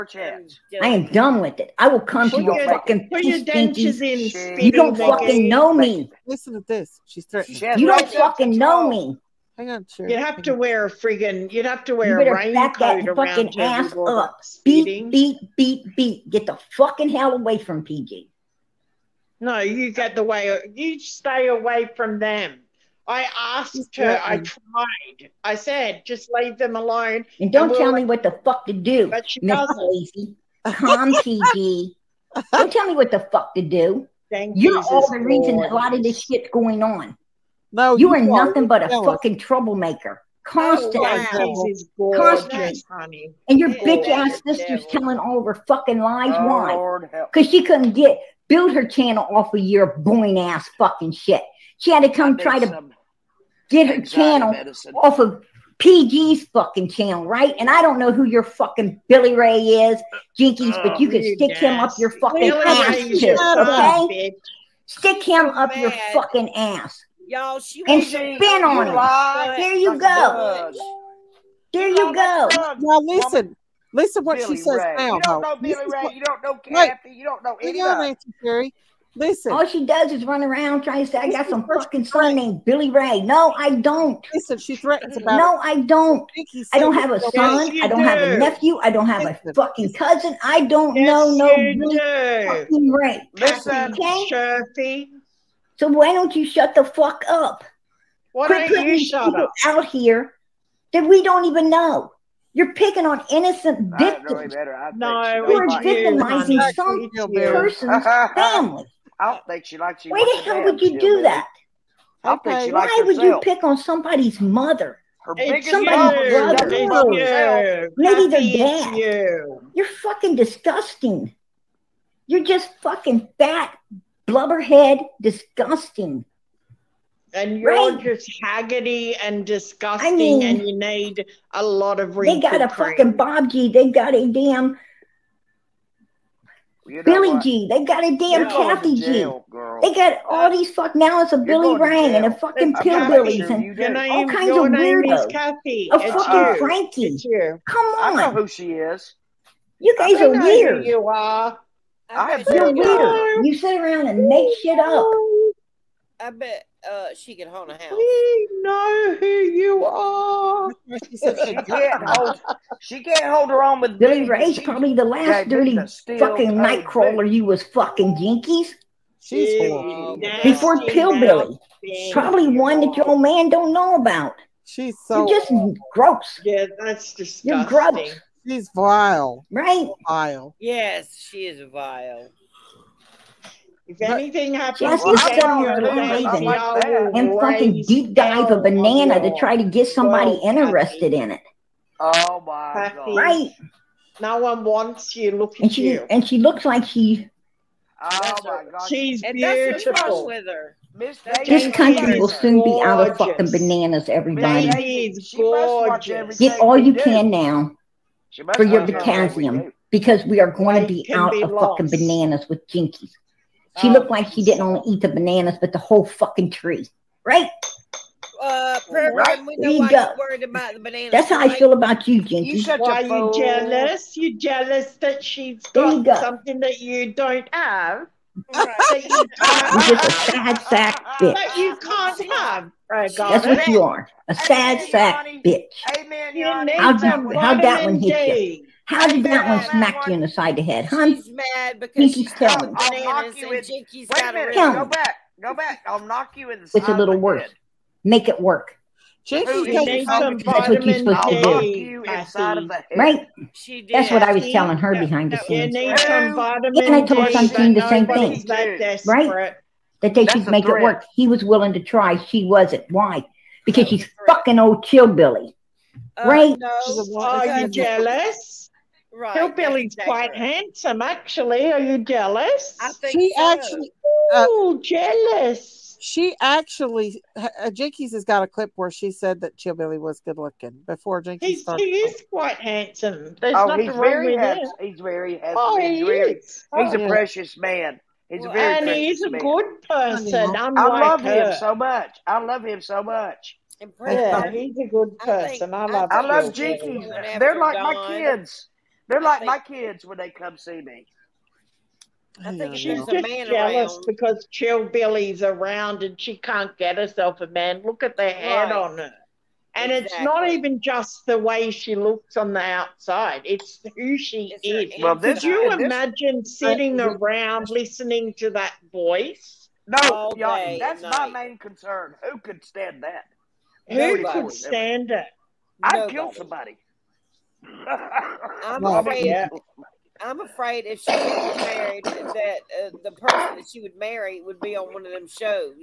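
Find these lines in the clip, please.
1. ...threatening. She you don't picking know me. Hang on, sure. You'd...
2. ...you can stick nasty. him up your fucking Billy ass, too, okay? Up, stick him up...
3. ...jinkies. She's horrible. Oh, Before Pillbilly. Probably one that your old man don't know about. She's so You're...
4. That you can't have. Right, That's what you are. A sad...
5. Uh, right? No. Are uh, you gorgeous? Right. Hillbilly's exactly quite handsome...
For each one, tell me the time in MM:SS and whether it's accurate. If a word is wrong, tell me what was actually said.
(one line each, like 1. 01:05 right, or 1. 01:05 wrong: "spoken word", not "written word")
1. 00:07 wrong: "fucking", not "picking"
2. 01:00 right
3. 02:48 right
4. 03:51 right
5. 04:26 wrong: "jealous", not "gorgeous".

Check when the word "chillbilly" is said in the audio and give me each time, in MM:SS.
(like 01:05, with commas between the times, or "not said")
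04:24, 04:39.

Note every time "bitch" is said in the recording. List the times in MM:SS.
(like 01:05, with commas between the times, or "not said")
00:43, 03:51, 03:55.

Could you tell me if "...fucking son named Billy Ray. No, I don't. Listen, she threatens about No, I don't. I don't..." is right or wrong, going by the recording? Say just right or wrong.
right.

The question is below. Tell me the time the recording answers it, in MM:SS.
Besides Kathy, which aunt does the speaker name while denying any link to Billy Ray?
01:17.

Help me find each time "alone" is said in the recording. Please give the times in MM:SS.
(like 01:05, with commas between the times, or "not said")
00:26.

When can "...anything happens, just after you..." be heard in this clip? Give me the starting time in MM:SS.
03:03.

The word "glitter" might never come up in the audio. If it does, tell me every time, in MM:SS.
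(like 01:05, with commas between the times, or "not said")
not said.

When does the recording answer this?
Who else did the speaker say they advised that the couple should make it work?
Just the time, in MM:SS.
04:17.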